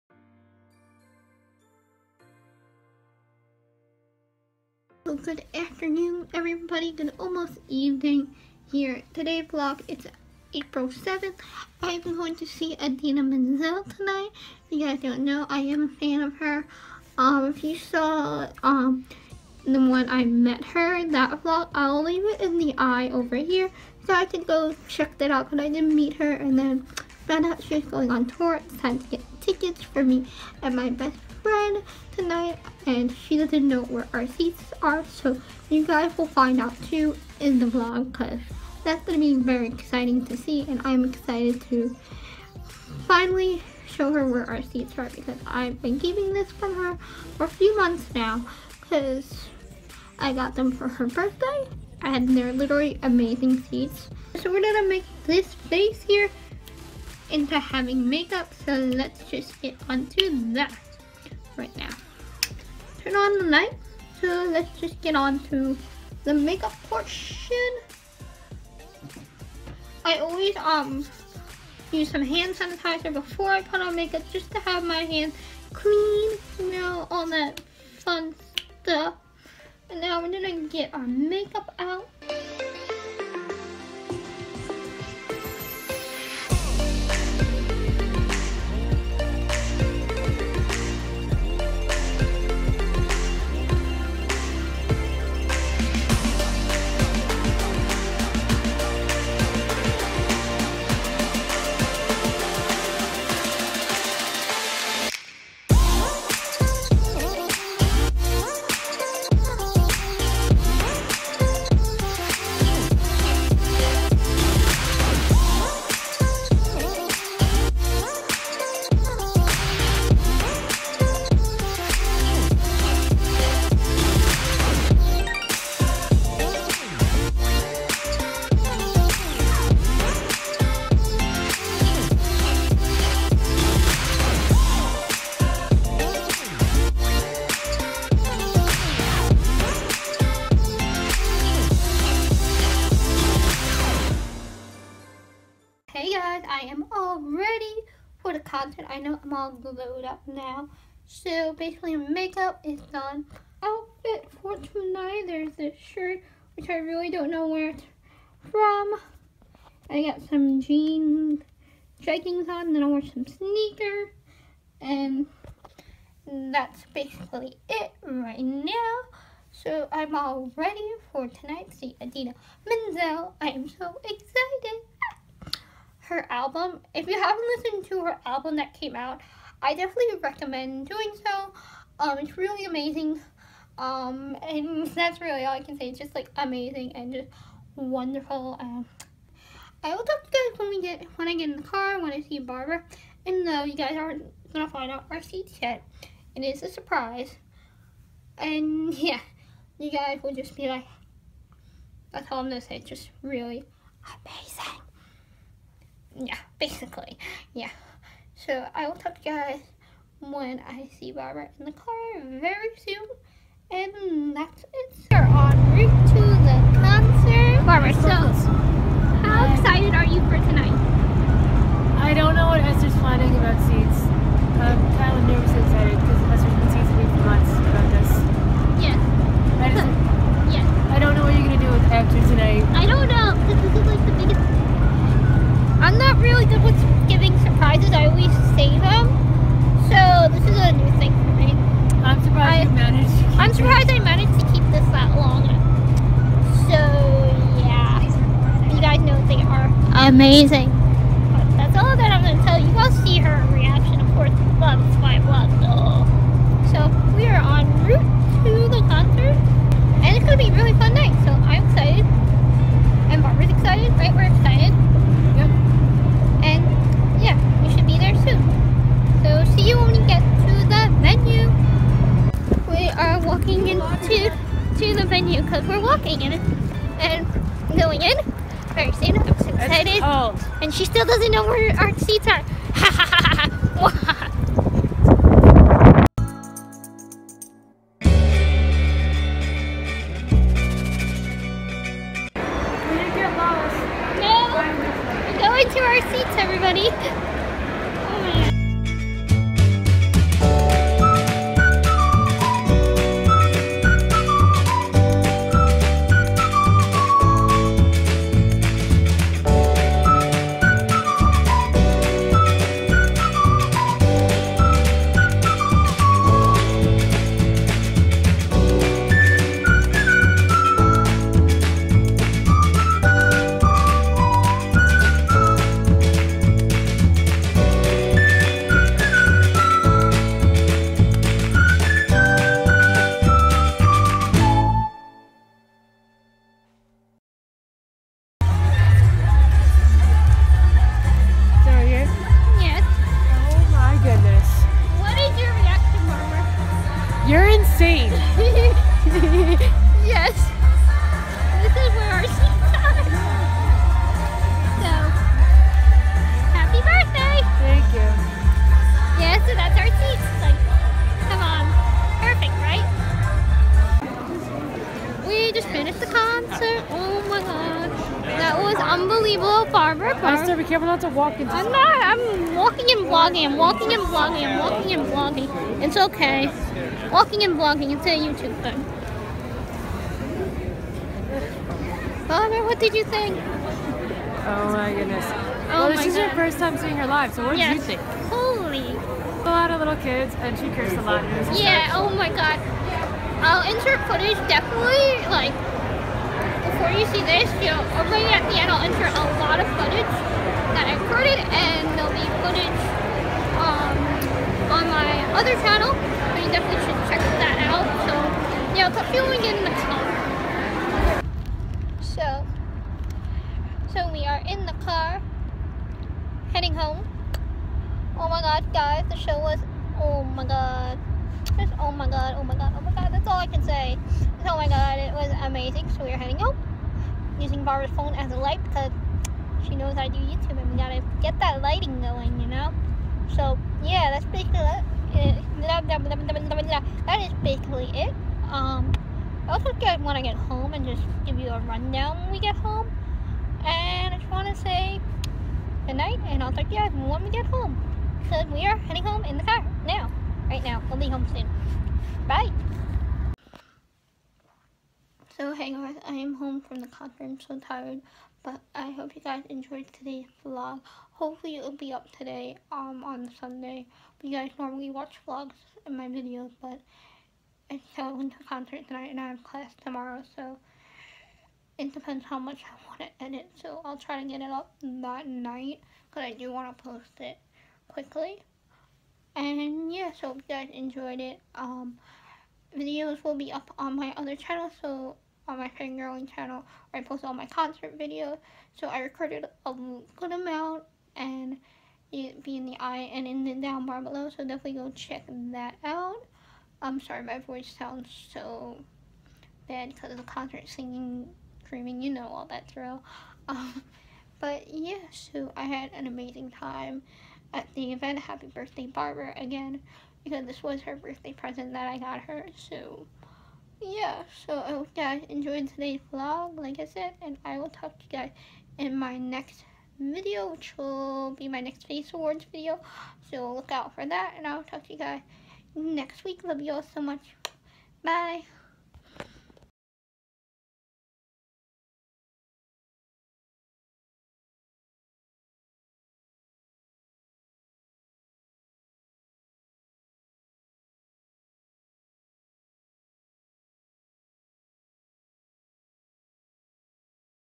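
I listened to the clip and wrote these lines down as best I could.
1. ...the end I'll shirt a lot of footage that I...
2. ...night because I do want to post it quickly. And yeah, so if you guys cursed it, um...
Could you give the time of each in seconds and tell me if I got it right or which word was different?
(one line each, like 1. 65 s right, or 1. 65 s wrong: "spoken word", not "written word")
1. 398 s wrong: "insert", not "shirt"
2. 475 s wrong: "enjoyed", not "cursed".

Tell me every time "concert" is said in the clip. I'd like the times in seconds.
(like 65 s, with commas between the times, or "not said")
216 s, 258 s, 456 s, 468 s, 487 s, 500 s.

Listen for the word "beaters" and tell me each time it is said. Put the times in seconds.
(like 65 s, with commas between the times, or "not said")
not said.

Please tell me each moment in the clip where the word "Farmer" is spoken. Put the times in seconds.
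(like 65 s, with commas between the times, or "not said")
369 s, 382 s.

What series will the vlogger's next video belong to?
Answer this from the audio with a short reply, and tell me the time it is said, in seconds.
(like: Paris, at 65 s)
Face Awards, at 521 s.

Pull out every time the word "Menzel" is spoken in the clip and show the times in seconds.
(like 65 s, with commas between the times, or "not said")
13 s, 172 s.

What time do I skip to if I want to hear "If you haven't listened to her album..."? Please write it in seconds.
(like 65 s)
176 s.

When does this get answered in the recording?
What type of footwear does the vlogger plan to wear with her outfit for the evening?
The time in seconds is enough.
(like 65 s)
163 s.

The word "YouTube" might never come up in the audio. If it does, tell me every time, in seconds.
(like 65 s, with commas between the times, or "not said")
378 s, 430 s.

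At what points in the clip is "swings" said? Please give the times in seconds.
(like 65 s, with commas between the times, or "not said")
not said.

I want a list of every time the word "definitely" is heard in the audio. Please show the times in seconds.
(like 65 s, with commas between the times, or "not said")
179 s, 394 s, 406 s, 494 s.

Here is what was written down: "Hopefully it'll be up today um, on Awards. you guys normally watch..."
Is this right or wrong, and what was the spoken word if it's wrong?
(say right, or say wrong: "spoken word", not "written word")
wrong: "Sunday", not "Awards".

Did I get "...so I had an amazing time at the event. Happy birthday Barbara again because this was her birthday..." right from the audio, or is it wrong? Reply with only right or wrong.
right.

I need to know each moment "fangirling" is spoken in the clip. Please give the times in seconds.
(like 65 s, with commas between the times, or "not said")
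485 s.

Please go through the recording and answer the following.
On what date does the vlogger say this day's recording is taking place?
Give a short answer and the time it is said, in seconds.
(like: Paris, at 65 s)
April 7th, at 10 s.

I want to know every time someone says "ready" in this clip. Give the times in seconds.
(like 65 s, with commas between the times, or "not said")
170 s.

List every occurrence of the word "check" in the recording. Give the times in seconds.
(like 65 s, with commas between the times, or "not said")
24 s, 407 s, 494 s.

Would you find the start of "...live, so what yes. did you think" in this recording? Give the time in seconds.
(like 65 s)
387 s.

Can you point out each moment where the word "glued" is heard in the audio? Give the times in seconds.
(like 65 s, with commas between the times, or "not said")
149 s.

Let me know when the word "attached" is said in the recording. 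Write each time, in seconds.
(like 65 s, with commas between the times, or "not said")
not said.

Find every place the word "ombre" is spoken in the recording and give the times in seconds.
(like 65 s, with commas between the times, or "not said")
not said.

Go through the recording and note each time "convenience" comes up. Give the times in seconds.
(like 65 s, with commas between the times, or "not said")
not said.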